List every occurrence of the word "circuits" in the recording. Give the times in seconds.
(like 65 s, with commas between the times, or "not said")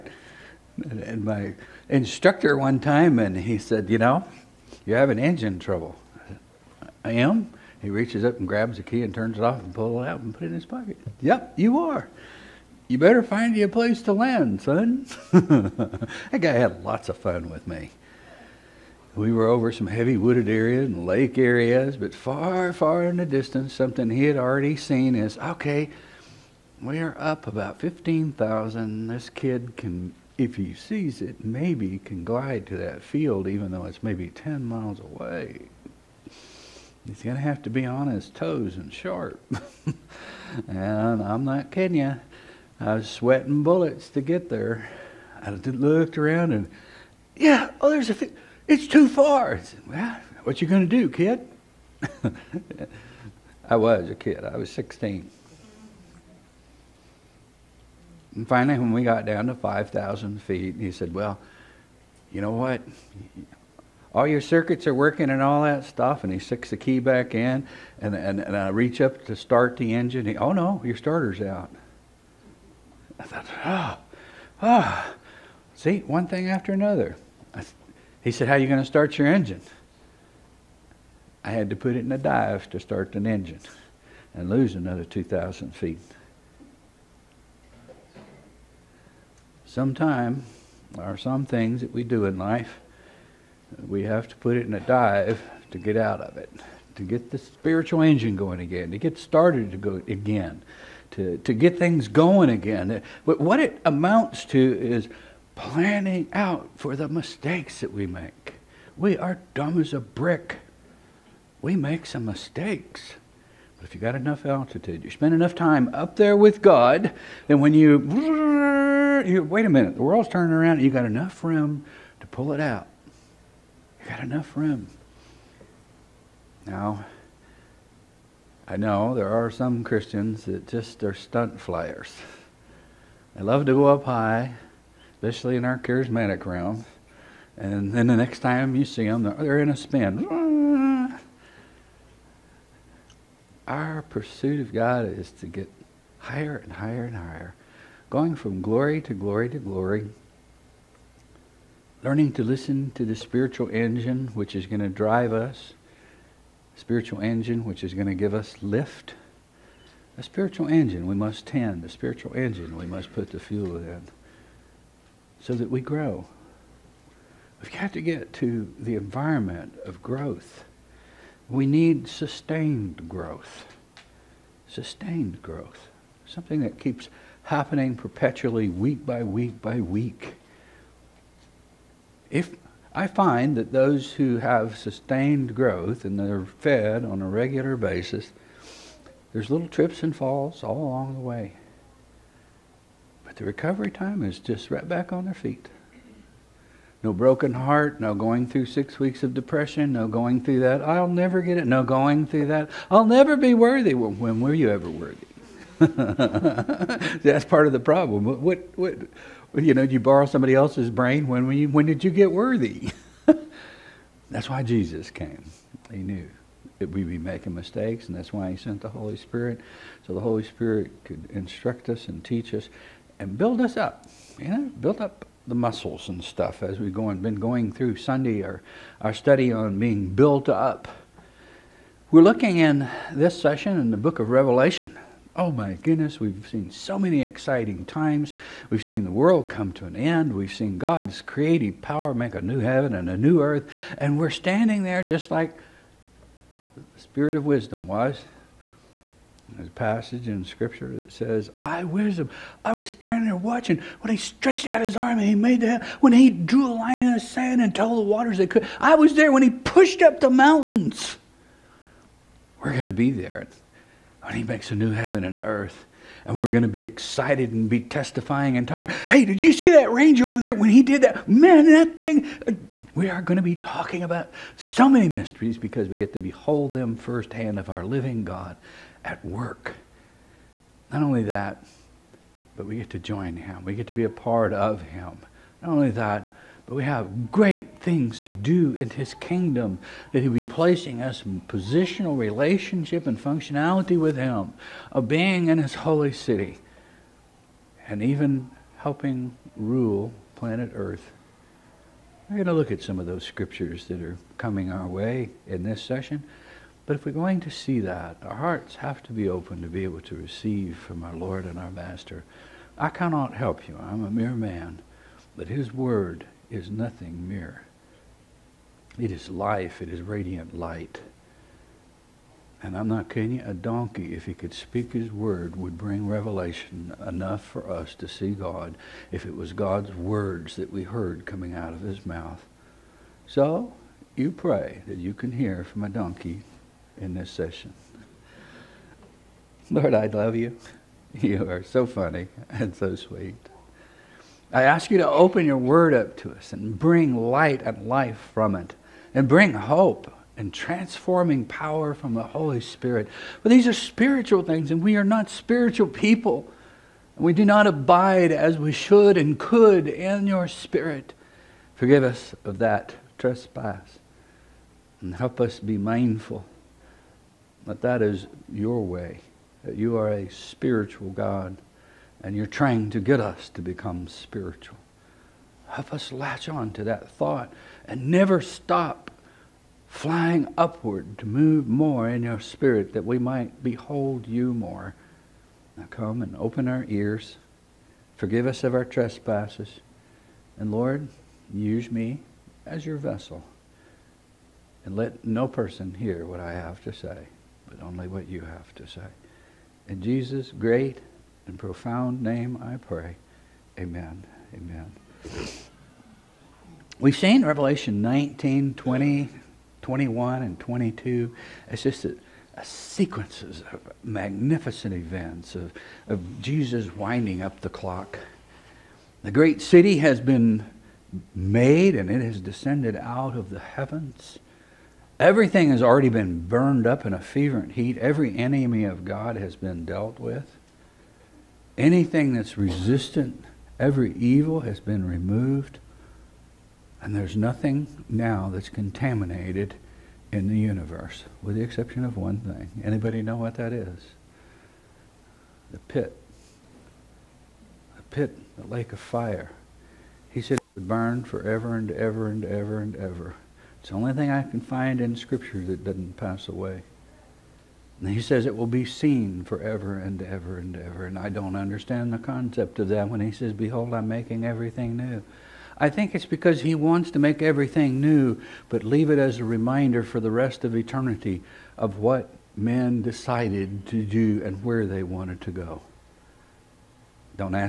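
64 s.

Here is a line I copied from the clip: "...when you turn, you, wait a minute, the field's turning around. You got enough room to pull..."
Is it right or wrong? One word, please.
wrong.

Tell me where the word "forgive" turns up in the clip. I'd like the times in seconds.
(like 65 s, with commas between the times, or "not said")
361 s, 388 s.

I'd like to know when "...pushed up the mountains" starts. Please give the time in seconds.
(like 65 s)
259 s.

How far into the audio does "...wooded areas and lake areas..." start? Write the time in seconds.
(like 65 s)
20 s.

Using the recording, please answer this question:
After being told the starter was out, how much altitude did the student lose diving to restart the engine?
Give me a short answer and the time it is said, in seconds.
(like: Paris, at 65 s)
2,000 feet, at 85 s.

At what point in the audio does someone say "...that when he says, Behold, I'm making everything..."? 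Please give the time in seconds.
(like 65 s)
462 s.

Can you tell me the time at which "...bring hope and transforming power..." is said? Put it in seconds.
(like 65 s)
349 s.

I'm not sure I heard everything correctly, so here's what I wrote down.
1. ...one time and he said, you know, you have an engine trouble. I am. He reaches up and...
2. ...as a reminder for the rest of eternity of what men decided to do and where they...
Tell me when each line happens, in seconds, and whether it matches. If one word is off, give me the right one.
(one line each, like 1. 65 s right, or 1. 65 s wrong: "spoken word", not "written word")
1. 2 s right
2. 469 s right.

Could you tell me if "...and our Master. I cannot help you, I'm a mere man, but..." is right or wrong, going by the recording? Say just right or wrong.
right.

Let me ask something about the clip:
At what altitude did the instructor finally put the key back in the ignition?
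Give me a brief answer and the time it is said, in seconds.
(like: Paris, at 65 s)
5,000 feet, at 59 s.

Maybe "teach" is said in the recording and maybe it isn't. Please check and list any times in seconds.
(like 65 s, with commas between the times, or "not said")
222 s.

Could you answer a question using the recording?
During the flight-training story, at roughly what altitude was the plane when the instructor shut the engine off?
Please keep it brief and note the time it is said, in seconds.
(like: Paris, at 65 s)
15,000 feet, at 27 s.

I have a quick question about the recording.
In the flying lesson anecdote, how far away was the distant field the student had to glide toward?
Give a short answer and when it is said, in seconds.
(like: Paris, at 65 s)
10 miles, at 34 s.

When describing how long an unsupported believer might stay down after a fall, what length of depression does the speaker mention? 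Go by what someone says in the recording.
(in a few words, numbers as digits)
6 weeks.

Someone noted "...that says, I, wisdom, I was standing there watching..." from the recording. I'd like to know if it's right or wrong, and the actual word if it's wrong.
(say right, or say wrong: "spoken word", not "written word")
right.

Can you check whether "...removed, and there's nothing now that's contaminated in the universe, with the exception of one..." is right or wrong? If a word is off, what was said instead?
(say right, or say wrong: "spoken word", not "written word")
right.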